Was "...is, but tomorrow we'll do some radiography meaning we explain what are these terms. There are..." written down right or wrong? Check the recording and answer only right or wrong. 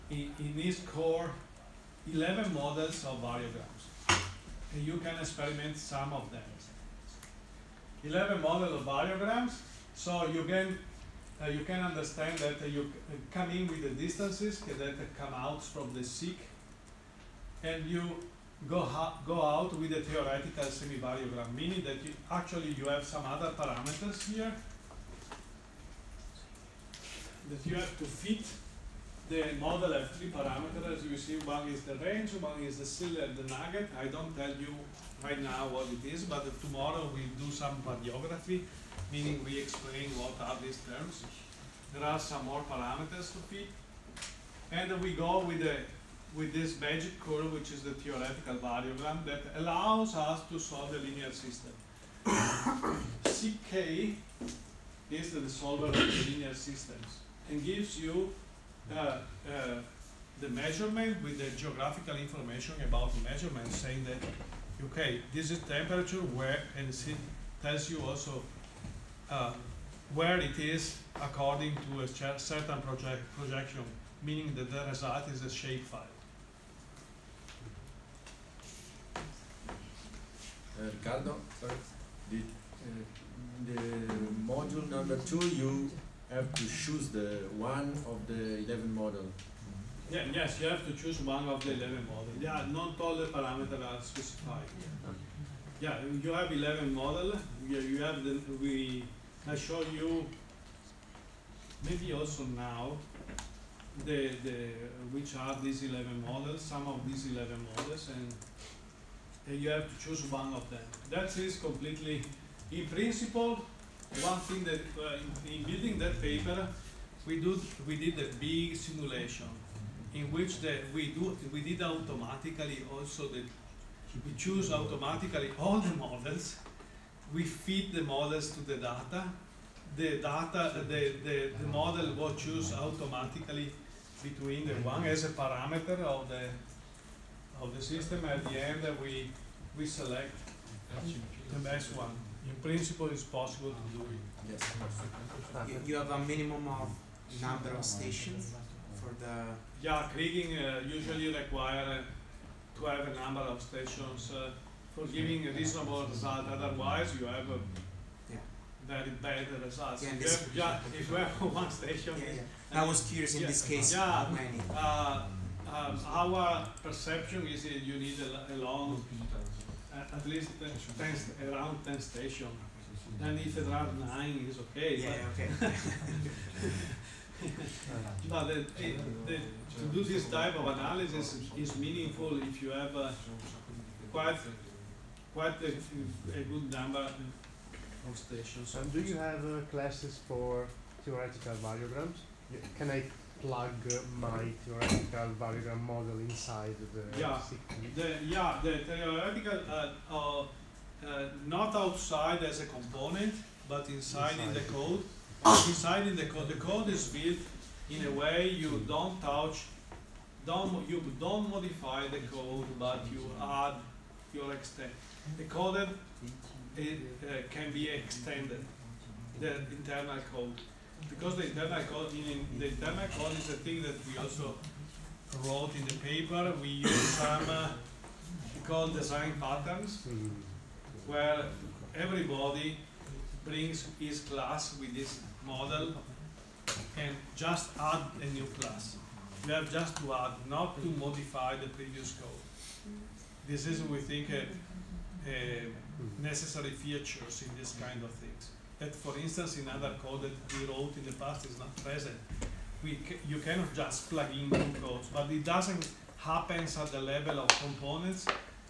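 right.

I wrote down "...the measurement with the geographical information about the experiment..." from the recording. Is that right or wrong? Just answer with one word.
wrong.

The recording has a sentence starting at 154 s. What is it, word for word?
Uh, for giving a reasonable result.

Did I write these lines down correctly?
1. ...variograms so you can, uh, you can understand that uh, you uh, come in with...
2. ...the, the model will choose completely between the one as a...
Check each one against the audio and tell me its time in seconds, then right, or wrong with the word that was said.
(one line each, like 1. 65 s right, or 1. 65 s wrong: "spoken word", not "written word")
1. 8 s right
2. 131 s wrong: "automatically", not "completely".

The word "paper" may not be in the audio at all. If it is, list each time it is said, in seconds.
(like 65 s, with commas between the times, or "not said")
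116 s, 225 s.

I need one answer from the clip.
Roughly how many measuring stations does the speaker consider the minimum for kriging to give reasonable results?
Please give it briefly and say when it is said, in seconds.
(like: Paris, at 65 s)
10, at 171 s.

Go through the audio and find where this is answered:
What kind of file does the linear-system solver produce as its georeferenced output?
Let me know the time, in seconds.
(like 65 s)
75 s.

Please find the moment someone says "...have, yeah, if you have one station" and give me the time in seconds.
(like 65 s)
160 s.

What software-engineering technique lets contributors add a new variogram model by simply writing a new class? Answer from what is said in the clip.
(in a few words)
design patterns.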